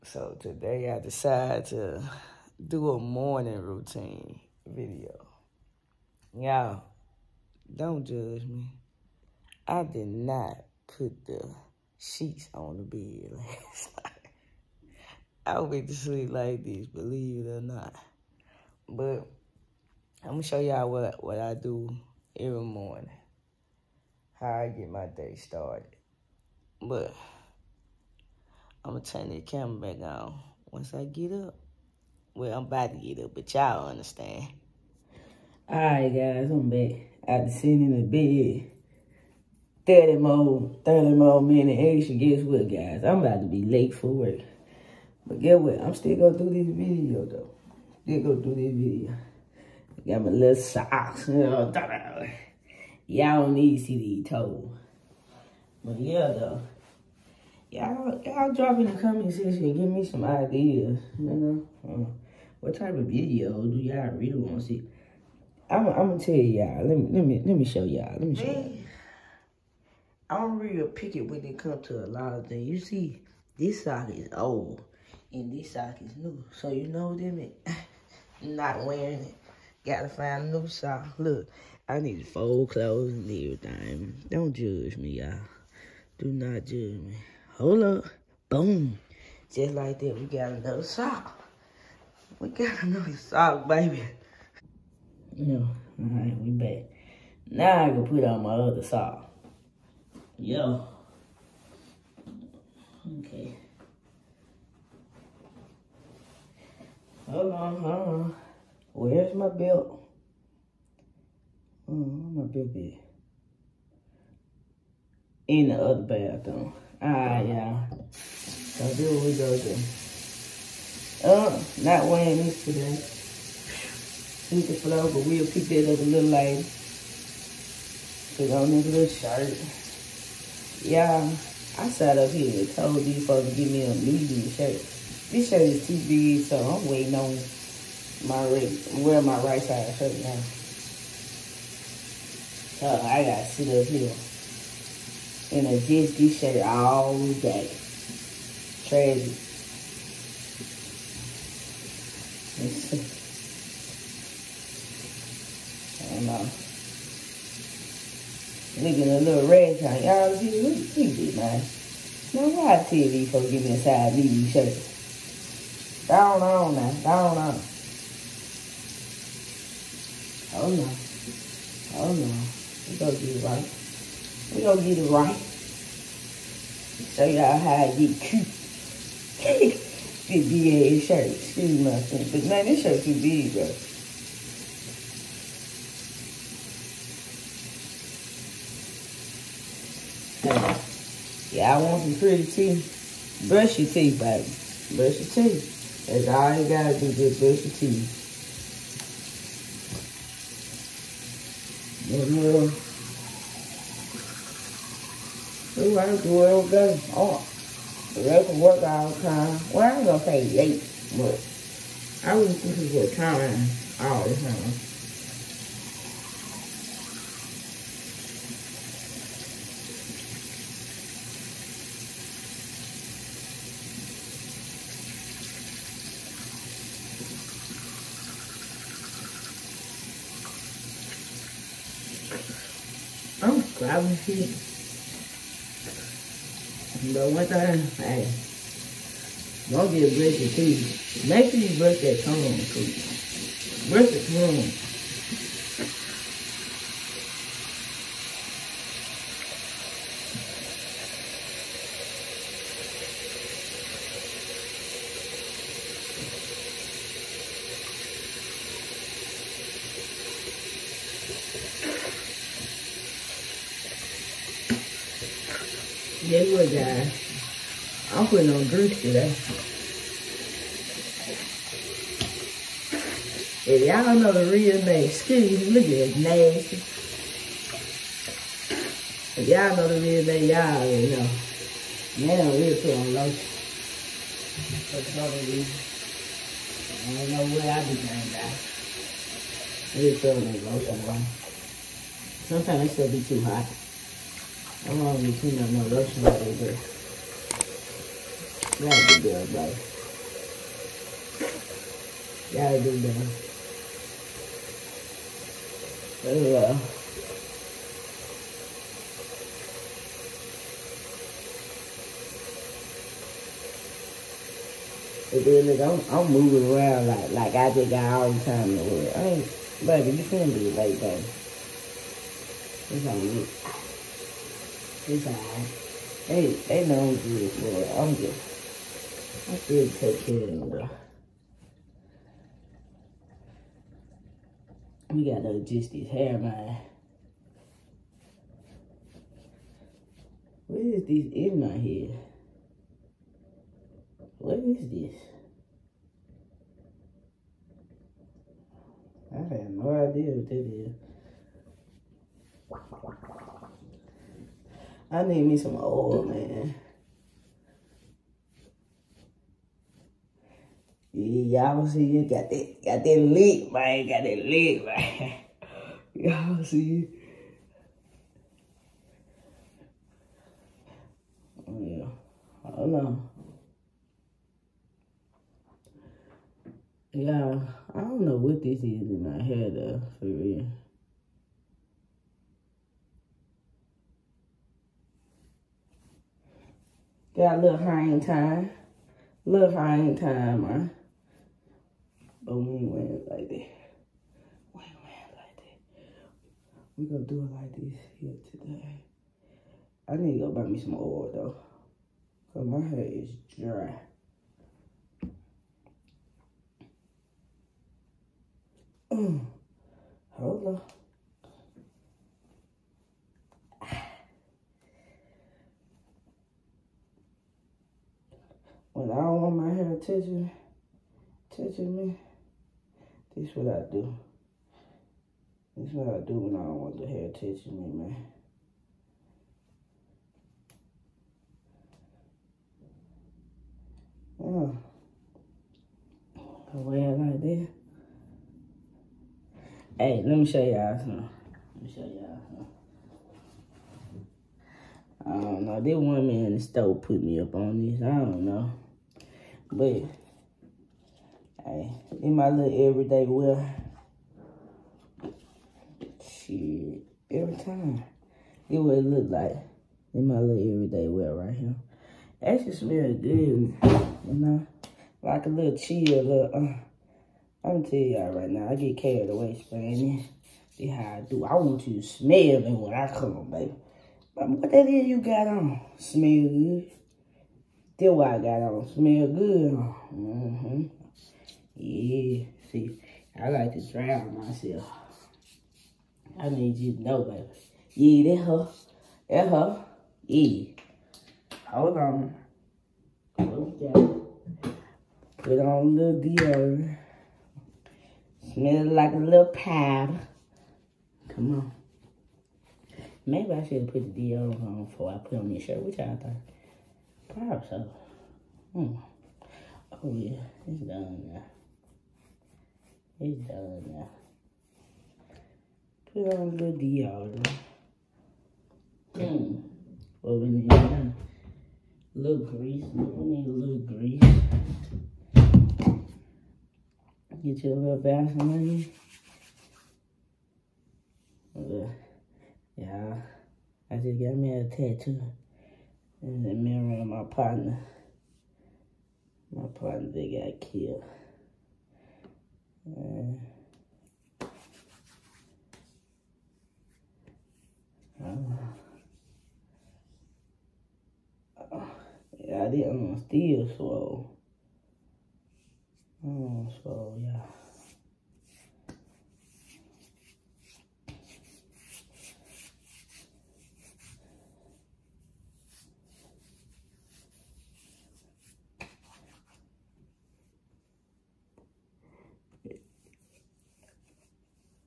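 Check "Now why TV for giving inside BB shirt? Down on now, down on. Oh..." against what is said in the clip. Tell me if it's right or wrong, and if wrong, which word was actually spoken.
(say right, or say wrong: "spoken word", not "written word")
right.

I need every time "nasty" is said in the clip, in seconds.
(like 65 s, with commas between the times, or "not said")
276 s.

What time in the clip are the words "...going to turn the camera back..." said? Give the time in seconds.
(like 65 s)
28 s.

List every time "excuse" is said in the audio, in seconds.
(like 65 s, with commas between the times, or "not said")
181 s, 275 s.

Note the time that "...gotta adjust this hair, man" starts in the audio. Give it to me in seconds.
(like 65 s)
335 s.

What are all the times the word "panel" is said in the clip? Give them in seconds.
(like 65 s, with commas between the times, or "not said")
not said.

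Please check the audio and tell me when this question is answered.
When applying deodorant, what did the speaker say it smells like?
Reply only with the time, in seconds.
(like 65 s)
499 s.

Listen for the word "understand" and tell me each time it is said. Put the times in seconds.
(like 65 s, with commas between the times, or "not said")
33 s.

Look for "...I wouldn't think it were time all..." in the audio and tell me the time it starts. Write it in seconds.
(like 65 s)
212 s.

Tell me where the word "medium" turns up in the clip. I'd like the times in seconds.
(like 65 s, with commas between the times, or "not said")
133 s.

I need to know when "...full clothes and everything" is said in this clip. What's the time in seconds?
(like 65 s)
82 s.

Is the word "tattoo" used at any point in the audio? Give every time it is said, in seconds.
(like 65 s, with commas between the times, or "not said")
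534 s.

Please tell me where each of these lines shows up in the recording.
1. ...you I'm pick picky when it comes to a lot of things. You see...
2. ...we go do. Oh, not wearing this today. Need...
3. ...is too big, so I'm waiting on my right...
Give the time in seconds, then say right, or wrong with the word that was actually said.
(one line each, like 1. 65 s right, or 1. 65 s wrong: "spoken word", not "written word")
1. 68 s right
2. 119 s right
3. 135 s right.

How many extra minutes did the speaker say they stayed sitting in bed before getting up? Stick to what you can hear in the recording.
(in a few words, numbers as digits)
30.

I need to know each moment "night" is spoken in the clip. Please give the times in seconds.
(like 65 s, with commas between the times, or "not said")
14 s.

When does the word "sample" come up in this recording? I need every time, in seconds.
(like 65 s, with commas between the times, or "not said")
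not said.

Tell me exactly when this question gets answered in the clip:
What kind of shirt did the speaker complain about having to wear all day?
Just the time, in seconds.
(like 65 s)
145 s.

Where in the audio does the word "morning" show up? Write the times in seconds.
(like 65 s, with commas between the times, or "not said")
2 s, 22 s.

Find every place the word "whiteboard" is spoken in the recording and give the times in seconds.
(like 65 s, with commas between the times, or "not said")
not said.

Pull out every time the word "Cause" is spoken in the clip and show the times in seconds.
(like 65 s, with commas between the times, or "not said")
402 s.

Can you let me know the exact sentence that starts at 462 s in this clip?
just smell good, you know, like a little chill.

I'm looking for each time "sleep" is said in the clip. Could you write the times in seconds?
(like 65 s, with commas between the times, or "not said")
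15 s.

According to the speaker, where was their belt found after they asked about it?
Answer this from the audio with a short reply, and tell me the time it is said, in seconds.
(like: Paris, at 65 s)
the other bathroom, at 115 s.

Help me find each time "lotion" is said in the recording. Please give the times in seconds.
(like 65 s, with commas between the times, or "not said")
283 s, 290 s, 295 s.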